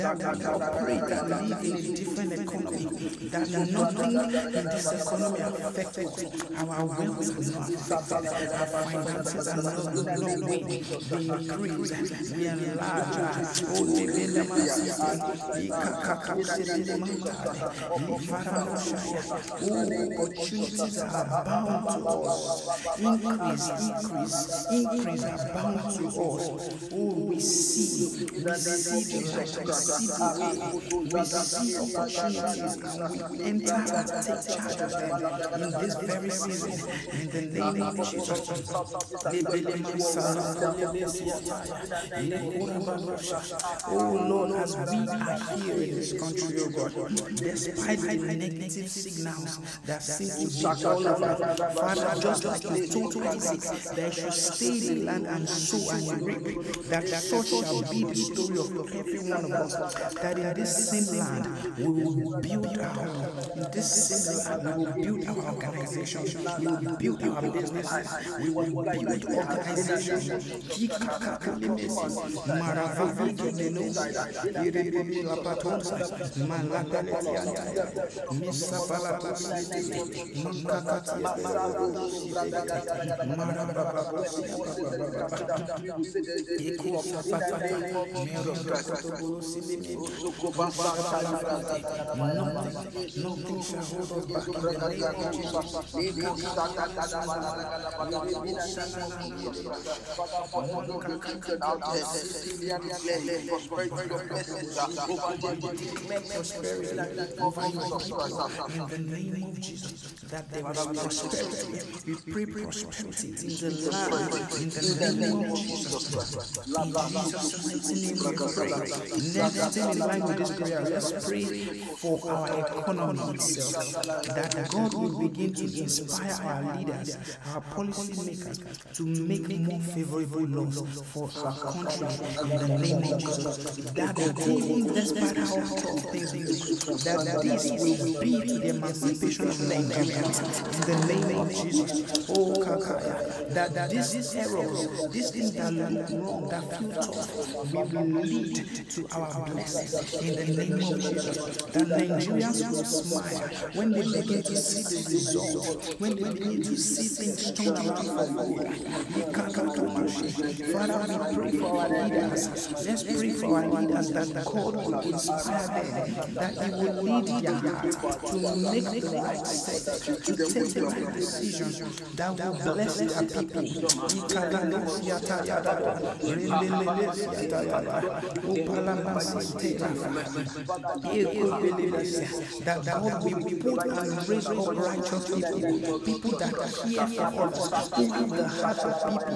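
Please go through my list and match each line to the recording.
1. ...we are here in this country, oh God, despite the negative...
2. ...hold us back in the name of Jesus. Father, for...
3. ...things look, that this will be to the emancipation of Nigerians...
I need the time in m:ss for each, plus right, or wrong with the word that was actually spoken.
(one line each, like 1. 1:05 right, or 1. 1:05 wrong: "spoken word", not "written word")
1. 0:44 right
2. 1:33 right
3. 2:16 right.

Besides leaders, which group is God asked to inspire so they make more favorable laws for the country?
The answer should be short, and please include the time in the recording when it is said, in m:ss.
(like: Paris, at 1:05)
policy makers, at 2:07.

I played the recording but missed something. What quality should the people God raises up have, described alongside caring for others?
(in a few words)
righteous.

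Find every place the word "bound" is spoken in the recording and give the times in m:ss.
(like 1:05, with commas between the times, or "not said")
0:21, 0:25.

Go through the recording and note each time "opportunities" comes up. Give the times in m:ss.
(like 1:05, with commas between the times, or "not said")
0:20, 0:31.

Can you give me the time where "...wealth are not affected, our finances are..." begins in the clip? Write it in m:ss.
0:06.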